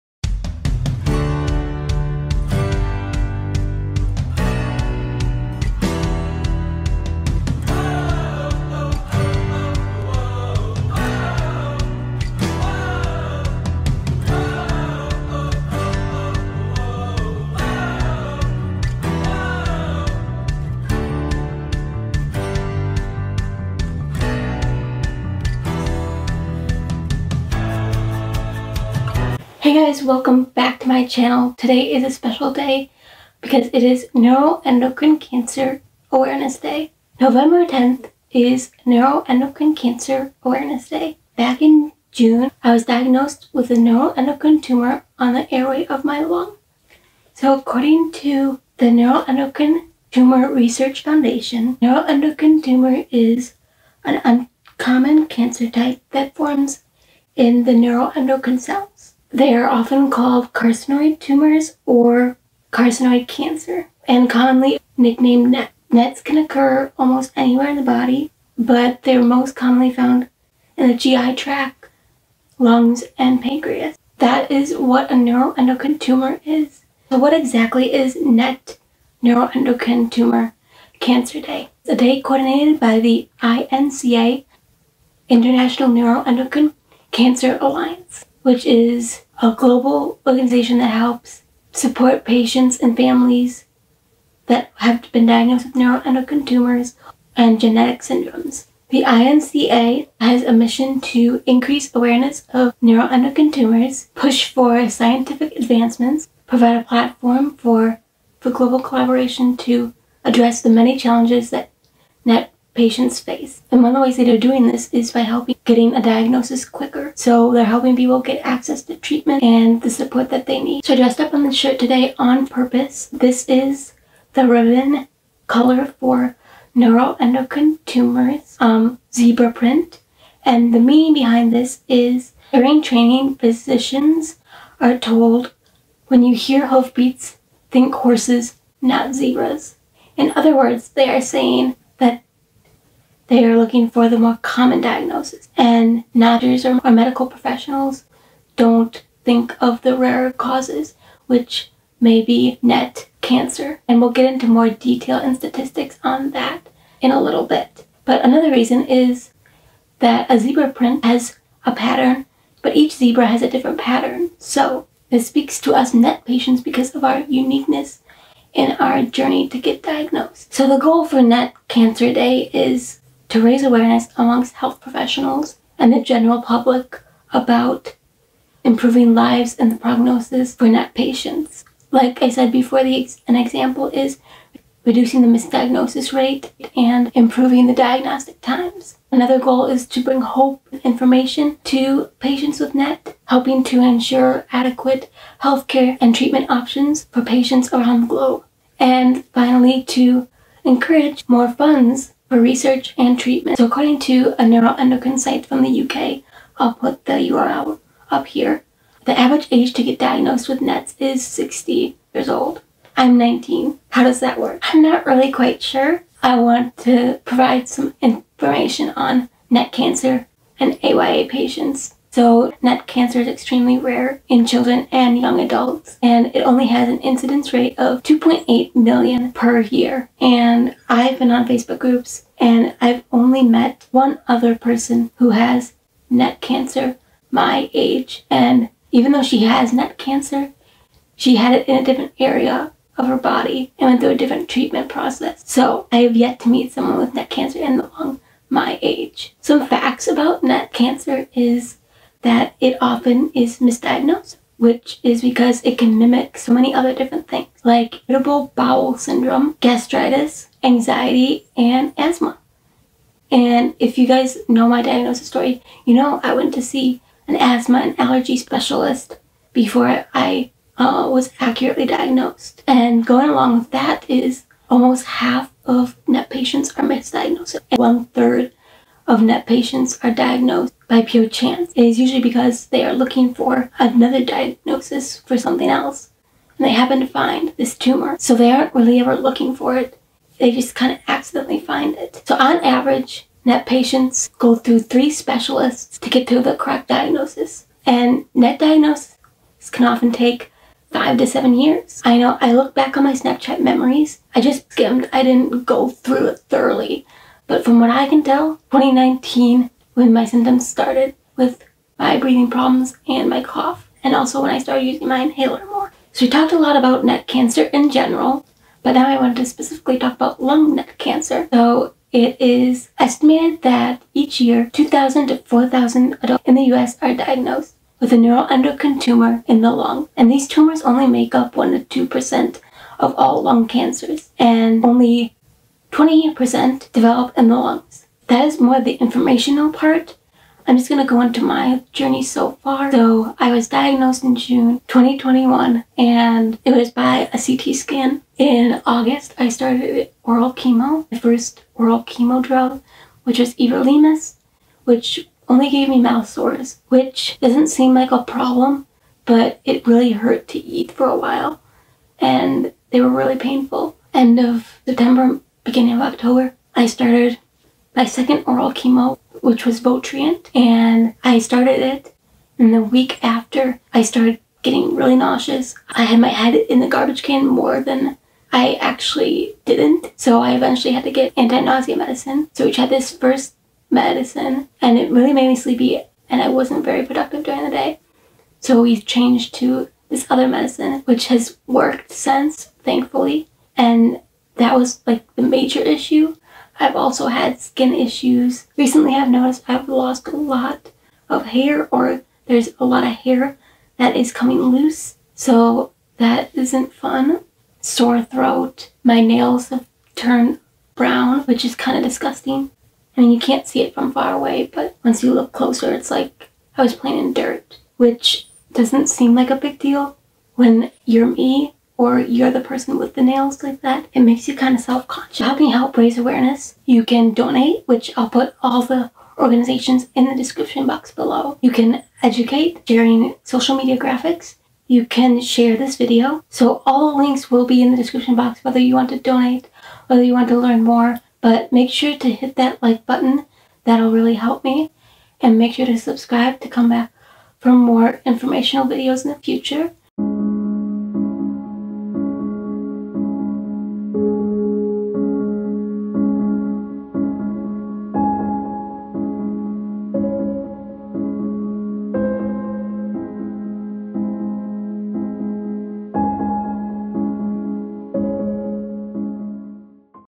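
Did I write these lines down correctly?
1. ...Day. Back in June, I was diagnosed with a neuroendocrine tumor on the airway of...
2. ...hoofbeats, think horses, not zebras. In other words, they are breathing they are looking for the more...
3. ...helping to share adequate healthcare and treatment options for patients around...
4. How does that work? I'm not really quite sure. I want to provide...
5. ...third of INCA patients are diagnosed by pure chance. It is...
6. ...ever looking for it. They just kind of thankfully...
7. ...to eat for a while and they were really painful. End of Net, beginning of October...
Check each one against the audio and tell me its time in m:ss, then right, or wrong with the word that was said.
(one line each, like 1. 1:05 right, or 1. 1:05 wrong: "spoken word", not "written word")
1. 0:40 right
2. 2:16 wrong: "saying", not "breathing"
3. 3:13 wrong: "ensure", not "share"
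4. 3:33 right
5. 4:38 wrong: "NET", not "INCA"
6. 4:48 wrong: "accidentally", not "thankfully"
7. 6:00 wrong: "September", not "Net".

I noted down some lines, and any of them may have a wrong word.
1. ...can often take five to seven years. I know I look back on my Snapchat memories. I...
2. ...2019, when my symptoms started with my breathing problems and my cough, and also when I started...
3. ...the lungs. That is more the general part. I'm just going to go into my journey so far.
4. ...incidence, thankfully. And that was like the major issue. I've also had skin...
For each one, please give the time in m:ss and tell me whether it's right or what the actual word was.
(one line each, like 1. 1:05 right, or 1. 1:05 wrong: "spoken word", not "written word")
1. 4:59 right
2. 5:08 right
3. 5:37 wrong: "informational", not "general"
4. 6:32 wrong: "since", not "incidence".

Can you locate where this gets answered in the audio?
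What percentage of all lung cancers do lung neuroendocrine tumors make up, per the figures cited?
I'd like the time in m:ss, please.
5:31.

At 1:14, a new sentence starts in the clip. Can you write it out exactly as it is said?
That is what a neuroendocrine tumor is.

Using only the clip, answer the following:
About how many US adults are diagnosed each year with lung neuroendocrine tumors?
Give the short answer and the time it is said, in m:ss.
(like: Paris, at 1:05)
2,000 to 4,000, at 5:24.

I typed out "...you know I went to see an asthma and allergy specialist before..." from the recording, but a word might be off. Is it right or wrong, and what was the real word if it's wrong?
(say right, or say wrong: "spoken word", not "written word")
right.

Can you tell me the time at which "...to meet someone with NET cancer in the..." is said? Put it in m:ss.
4:06.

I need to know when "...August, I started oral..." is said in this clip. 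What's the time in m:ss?
5:48.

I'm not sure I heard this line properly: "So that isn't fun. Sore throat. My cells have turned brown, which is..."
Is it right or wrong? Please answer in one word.
wrong.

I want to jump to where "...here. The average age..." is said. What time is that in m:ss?
3:28.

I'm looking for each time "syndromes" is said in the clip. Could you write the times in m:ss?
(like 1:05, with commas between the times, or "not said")
1:38, 4:18.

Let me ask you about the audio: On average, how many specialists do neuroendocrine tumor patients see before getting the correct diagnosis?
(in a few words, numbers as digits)
3.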